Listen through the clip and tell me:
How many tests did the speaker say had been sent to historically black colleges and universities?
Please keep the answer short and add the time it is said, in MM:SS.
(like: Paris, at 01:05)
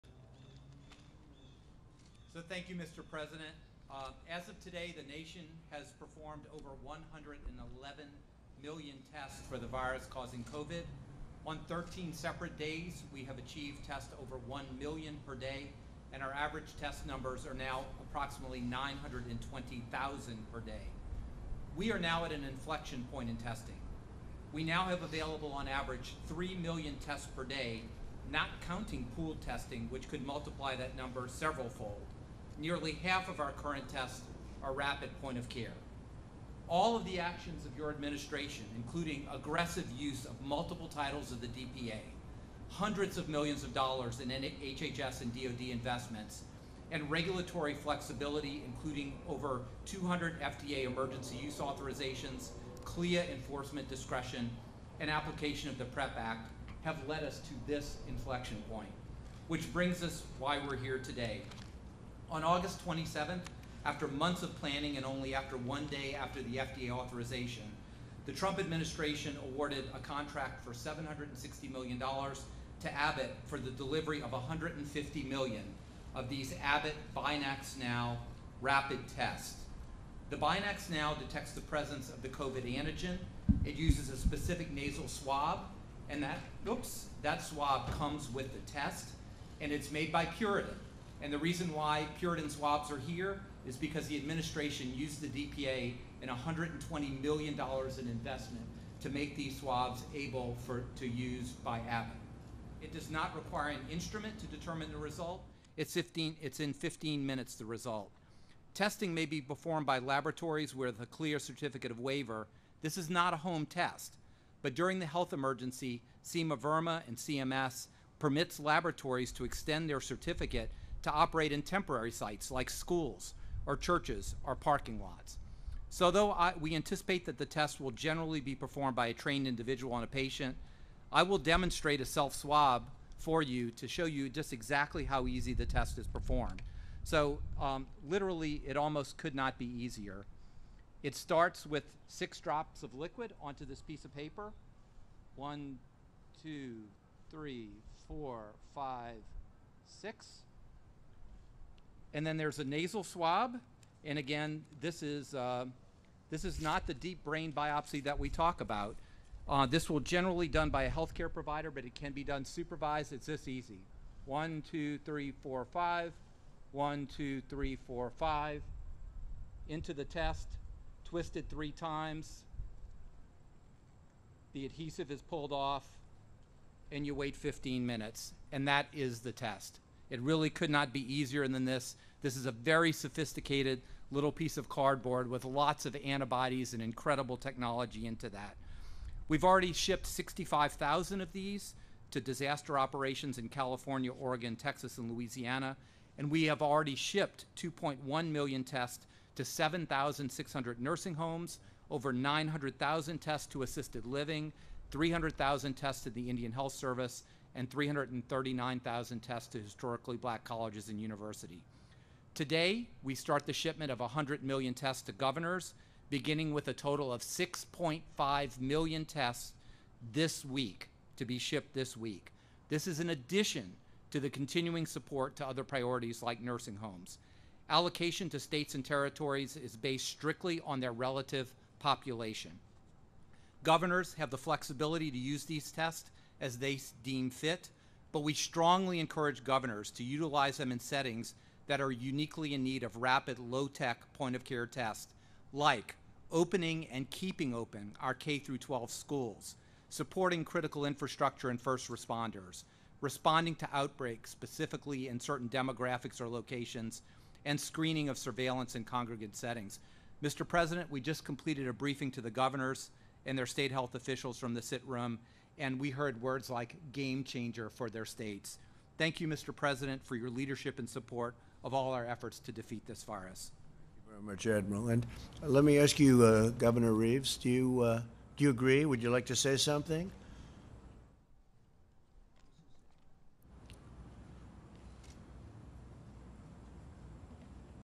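339,000, at 03:27.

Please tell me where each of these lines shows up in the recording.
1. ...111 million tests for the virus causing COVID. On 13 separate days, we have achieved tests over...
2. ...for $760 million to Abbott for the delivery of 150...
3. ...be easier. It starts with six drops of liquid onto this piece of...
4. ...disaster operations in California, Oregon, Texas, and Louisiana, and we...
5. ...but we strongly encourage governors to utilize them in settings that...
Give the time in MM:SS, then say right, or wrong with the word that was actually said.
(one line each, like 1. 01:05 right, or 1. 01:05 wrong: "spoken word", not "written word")
1. 00:06 right
2. 01:10 right
3. 02:19 right
4. 03:12 right
5. 03:58 right.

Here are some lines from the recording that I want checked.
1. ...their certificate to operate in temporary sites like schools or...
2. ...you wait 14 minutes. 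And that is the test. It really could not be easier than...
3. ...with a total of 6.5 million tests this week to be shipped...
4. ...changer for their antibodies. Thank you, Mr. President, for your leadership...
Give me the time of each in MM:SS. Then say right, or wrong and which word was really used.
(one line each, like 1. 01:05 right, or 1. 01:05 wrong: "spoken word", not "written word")
1. 01:59 right
2. 02:57 wrong: "15", not "14"
3. 03:36 right
4. 04:27 wrong: "states", not "antibodies".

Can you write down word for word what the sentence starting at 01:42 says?
It does not require an instrument to determine the result.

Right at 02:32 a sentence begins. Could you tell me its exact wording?
And then there's a nasal swab.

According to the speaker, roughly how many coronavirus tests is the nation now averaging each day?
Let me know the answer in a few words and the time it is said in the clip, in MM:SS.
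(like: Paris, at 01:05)
920,000, at 00:18.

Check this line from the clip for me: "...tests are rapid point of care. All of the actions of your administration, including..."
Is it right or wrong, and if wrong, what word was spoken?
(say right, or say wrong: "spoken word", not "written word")
right.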